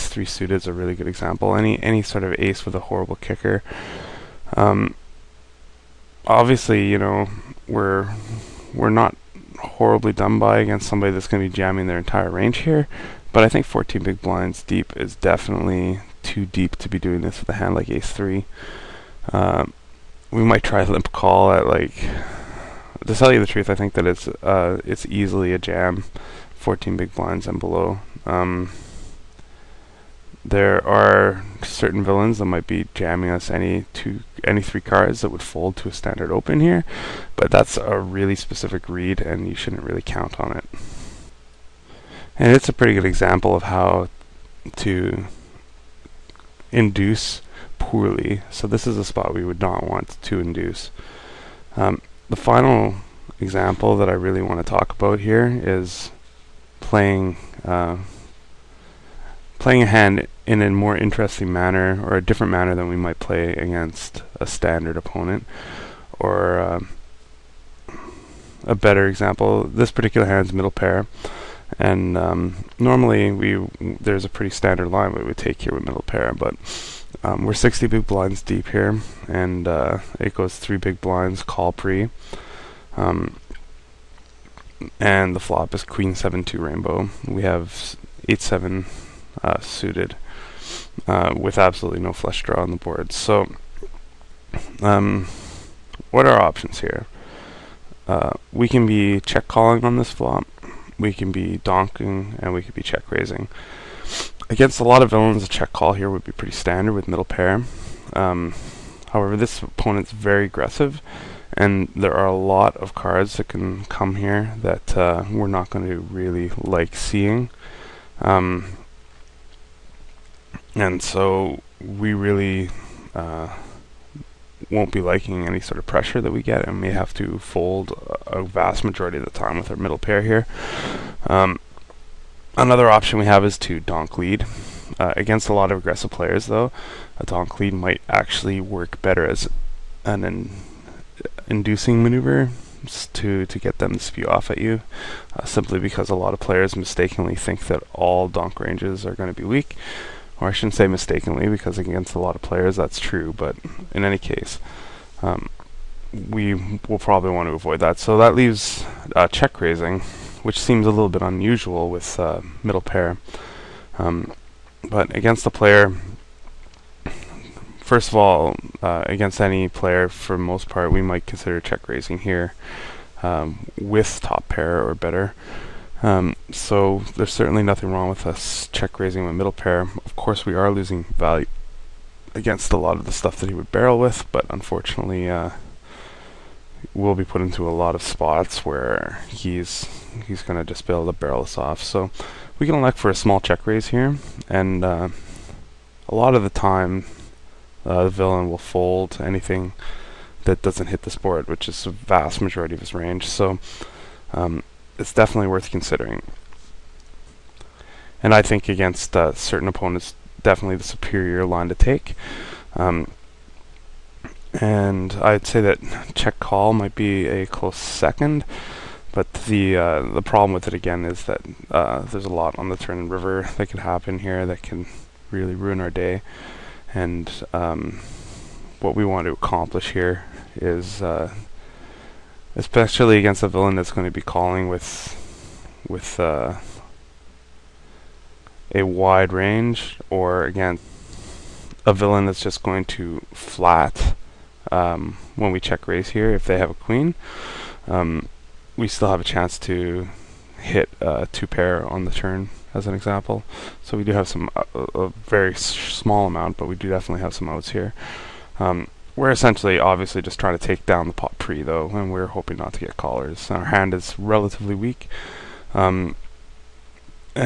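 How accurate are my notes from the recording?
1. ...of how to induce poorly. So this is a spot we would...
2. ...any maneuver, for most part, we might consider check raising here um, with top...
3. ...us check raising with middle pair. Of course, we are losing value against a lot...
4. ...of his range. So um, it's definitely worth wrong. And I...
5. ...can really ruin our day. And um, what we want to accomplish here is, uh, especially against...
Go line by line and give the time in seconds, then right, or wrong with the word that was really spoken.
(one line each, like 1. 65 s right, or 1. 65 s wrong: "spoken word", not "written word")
1. 43 s right
2. 169 s wrong: "player", not "maneuver"
3. 178 s right
4. 202 s wrong: "considering", not "wrong"
5. 224 s right.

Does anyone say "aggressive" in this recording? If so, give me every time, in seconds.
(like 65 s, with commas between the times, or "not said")
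110 s, 135 s.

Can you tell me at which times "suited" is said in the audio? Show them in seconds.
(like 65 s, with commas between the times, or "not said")
0 s, 89 s.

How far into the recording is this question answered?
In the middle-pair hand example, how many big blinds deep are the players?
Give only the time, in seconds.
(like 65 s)
77 s.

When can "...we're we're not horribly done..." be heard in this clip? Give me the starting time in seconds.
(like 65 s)
7 s.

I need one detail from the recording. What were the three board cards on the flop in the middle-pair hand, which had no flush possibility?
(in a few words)
Queen 7 2.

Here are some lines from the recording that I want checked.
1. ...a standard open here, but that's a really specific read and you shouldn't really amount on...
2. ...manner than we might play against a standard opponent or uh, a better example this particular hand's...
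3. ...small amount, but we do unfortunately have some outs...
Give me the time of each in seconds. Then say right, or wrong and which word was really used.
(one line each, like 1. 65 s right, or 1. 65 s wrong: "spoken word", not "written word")
1. 35 s wrong: "count", not "amount"
2. 62 s right
3. 255 s wrong: "definitely", not "unfortunately".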